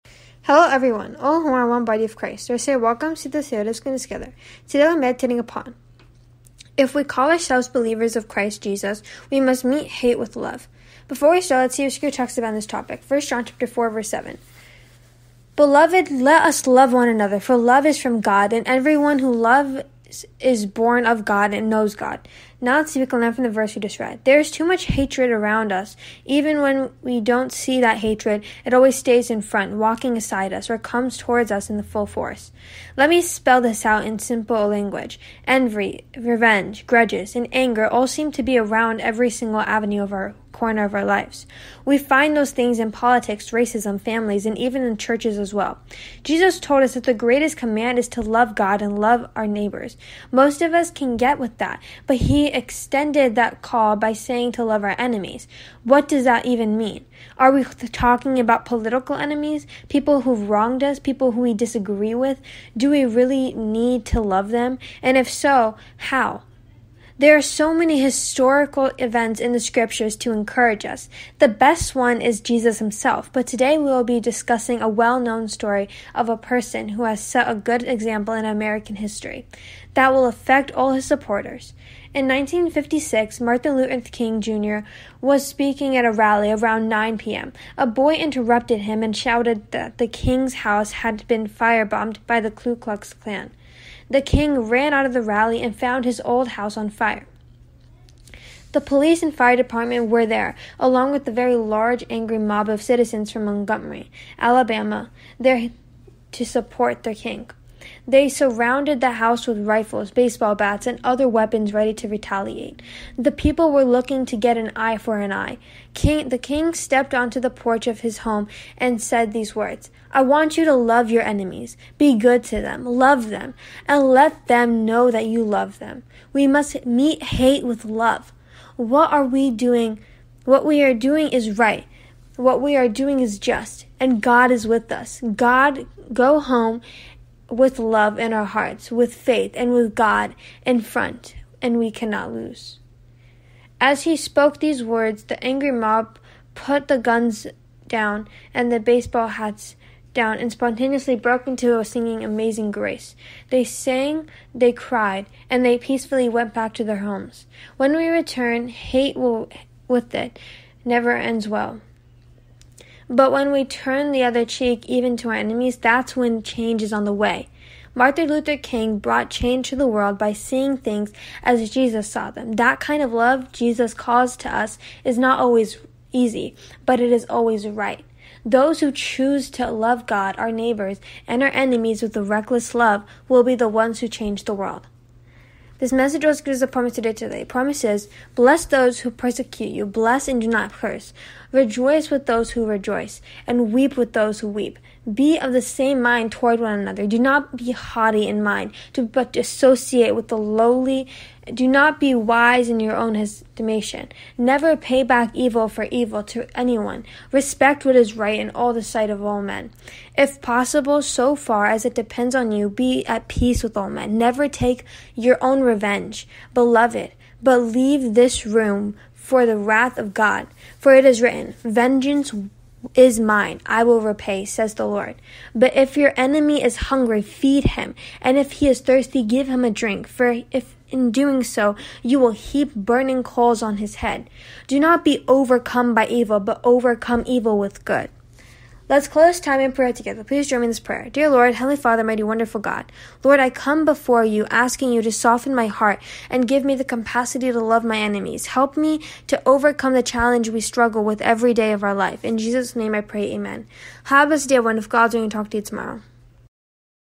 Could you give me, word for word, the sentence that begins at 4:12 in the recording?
In Jesus' name I pray, Amen.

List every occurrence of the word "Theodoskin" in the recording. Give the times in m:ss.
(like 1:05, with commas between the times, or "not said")
0:03.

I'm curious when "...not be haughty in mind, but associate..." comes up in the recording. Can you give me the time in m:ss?
3:17.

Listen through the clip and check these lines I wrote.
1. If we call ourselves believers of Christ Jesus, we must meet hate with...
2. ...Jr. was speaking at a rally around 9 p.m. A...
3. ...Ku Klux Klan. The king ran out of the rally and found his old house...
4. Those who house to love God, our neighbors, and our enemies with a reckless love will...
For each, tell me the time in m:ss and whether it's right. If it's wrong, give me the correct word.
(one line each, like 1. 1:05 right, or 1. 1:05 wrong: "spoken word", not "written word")
1. 0:06 right
2. 1:24 right
3. 1:32 right
4. 2:58 wrong: "choose", not "house".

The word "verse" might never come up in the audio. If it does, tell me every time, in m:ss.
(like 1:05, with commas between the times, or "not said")
0:13, 0:23.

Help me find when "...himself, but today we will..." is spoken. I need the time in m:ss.
1:12.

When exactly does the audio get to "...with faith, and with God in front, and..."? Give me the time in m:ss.
2:18.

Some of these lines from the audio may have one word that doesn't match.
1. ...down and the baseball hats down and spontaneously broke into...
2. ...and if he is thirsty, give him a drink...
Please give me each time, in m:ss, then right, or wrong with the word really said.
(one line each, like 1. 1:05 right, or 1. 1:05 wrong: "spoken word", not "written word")
1. 2:27 right
2. 3:48 right.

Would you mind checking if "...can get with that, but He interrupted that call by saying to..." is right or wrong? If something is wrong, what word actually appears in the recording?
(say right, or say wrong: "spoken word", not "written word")
wrong: "extended", not "interrupted".